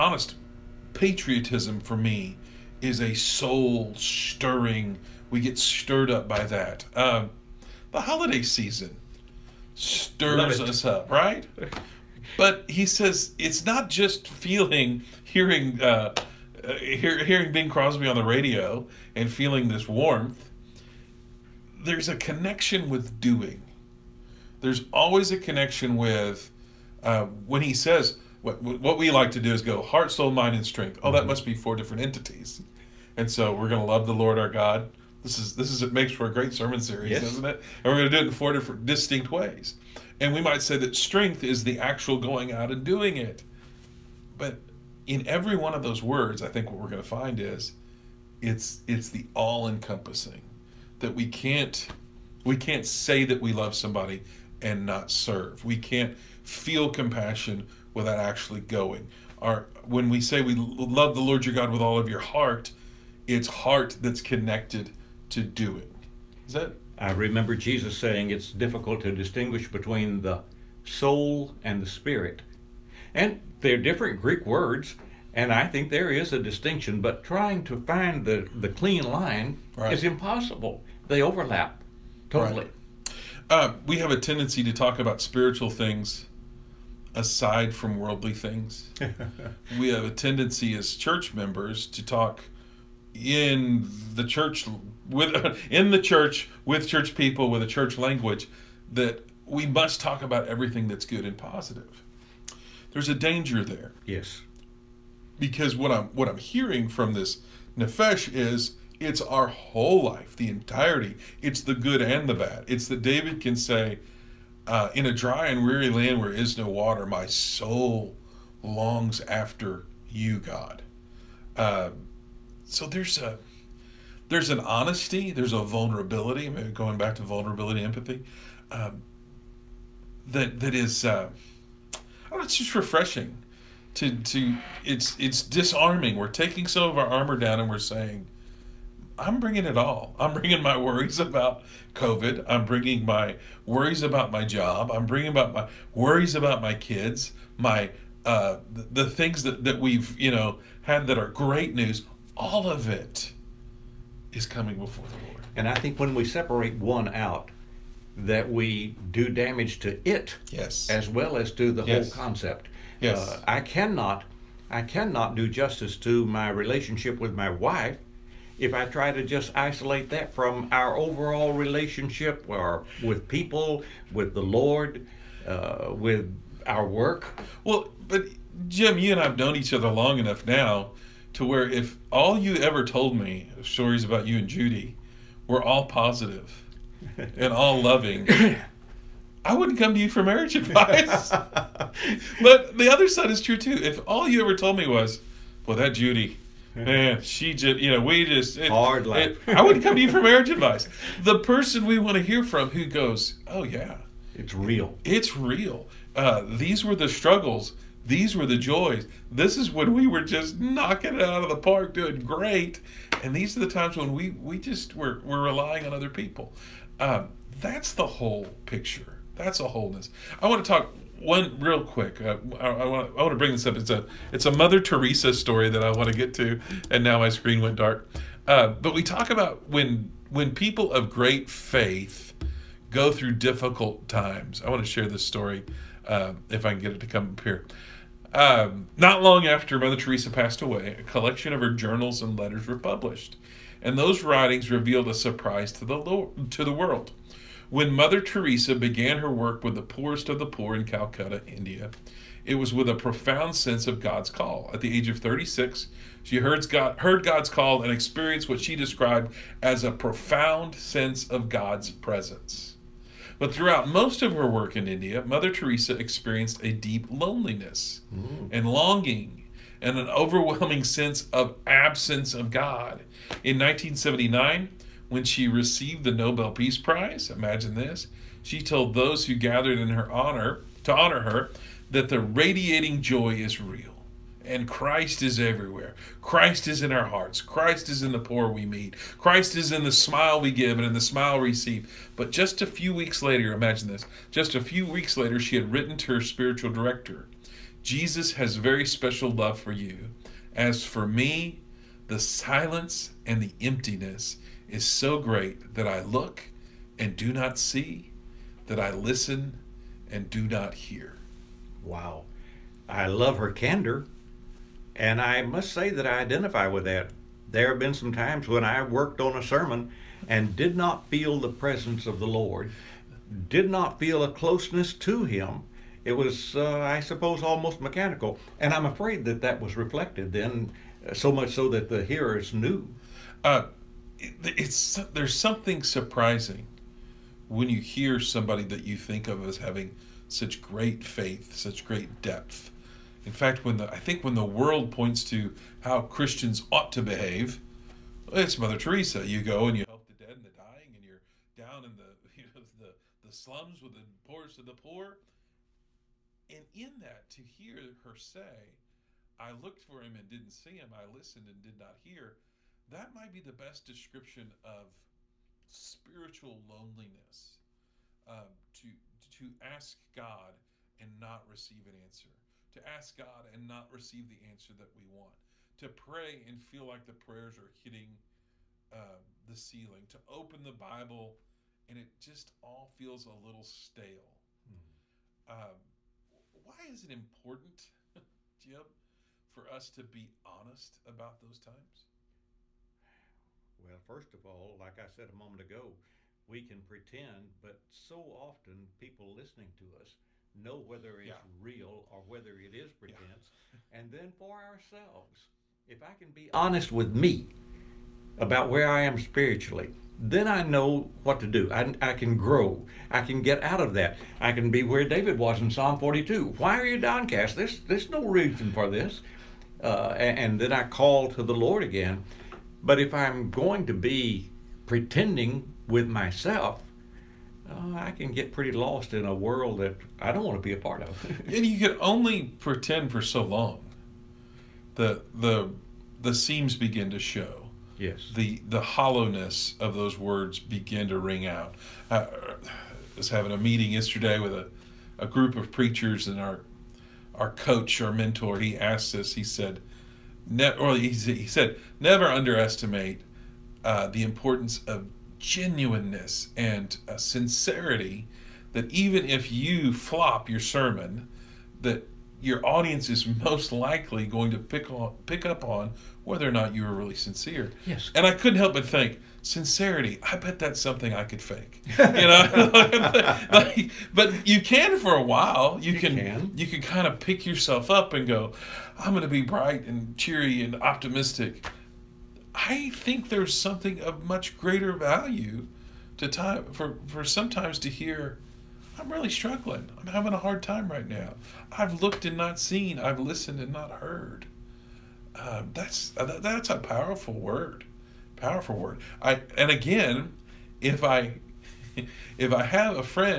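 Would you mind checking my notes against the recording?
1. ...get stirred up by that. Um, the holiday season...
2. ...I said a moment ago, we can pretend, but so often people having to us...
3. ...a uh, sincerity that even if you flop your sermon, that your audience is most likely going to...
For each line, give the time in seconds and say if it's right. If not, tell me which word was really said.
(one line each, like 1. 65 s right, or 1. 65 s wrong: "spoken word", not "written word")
1. 5 s right
2. 394 s wrong: "listening", not "having"
3. 457 s right.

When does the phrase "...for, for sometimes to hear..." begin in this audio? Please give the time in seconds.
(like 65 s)
486 s.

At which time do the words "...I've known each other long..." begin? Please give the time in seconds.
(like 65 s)
179 s.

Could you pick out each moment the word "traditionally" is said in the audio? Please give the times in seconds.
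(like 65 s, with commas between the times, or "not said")
not said.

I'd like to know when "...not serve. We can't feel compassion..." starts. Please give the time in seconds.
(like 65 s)
54 s.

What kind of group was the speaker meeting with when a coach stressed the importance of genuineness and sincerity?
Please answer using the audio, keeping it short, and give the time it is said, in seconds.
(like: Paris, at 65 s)
A group of preachers, at 445 s.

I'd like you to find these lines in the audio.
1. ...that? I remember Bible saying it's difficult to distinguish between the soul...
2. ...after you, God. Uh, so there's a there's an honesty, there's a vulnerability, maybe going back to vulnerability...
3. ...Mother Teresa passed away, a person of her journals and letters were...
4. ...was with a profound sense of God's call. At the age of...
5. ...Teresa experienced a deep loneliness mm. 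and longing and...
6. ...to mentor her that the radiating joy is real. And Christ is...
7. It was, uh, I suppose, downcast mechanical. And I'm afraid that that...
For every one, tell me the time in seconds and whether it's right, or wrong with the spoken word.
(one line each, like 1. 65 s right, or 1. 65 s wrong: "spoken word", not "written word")
1. 66 s wrong: "Jesus", not "Bible"
2. 119 s right
3. 239 s wrong: "collection", not "person"
4. 252 s right
5. 265 s right
6. 280 s wrong: "honor", not "mentor"
7. 326 s wrong: "almost", not "downcast".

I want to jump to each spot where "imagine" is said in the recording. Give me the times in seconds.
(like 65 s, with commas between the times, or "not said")
277 s, 293 s.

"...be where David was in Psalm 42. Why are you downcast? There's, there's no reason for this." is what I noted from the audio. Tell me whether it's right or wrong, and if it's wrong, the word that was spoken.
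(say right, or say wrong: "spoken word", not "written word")
right.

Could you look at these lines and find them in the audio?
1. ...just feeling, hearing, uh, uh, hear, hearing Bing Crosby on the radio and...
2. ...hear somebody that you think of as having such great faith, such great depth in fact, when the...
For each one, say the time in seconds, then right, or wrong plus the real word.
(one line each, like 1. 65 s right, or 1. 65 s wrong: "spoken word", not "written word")
1. 13 s right
2. 337 s right.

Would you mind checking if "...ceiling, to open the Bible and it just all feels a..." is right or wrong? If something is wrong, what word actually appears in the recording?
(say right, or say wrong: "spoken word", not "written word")
right.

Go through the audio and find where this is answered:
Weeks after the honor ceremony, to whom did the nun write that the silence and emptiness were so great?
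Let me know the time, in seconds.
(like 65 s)
296 s.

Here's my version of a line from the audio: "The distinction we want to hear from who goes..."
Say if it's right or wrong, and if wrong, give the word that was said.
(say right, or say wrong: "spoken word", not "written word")
wrong: "person", not "distinction".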